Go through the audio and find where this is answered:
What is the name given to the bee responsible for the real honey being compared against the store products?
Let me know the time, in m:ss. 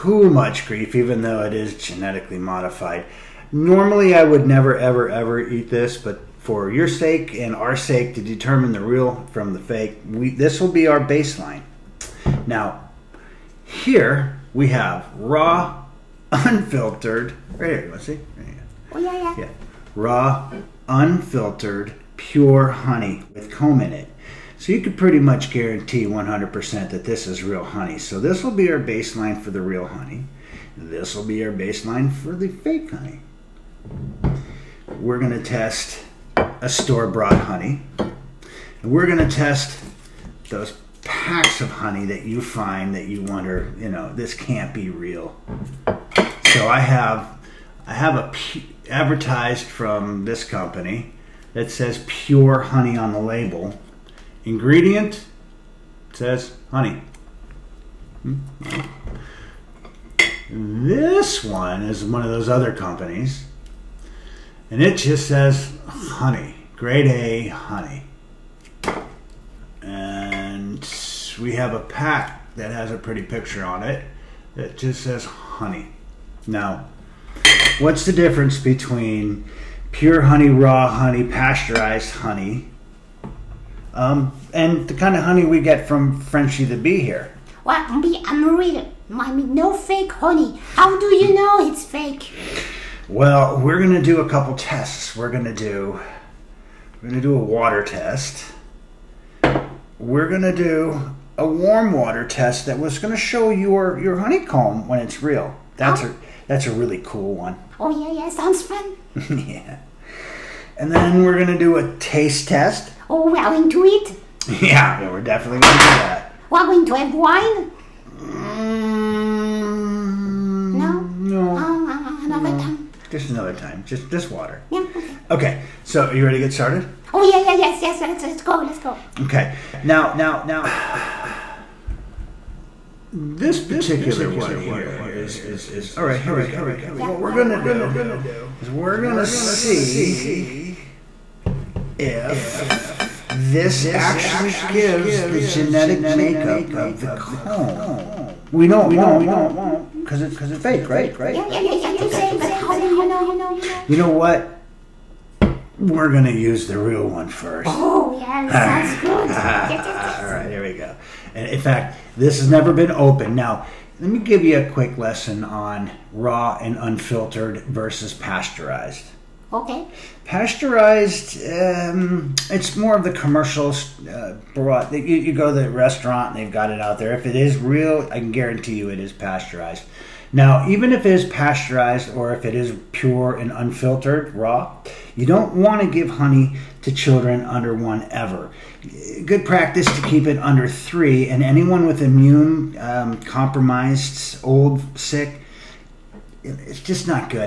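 1:26.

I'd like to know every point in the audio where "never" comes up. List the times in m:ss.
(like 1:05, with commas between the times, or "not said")
0:04, 2:42.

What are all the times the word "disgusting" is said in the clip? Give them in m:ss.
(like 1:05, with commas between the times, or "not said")
not said.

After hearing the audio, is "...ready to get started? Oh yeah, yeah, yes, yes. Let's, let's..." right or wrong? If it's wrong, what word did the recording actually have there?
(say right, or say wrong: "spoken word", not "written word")
right.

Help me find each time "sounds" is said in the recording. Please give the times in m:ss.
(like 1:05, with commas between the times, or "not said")
1:48.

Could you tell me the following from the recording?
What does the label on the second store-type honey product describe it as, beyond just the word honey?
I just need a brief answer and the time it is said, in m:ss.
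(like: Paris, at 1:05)
grade A honey, at 1:06.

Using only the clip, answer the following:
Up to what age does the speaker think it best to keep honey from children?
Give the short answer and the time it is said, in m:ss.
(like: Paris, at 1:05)
3, at 3:10.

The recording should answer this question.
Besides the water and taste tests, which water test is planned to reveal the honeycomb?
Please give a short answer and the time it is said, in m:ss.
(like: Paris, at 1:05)
warm water test, at 1:41.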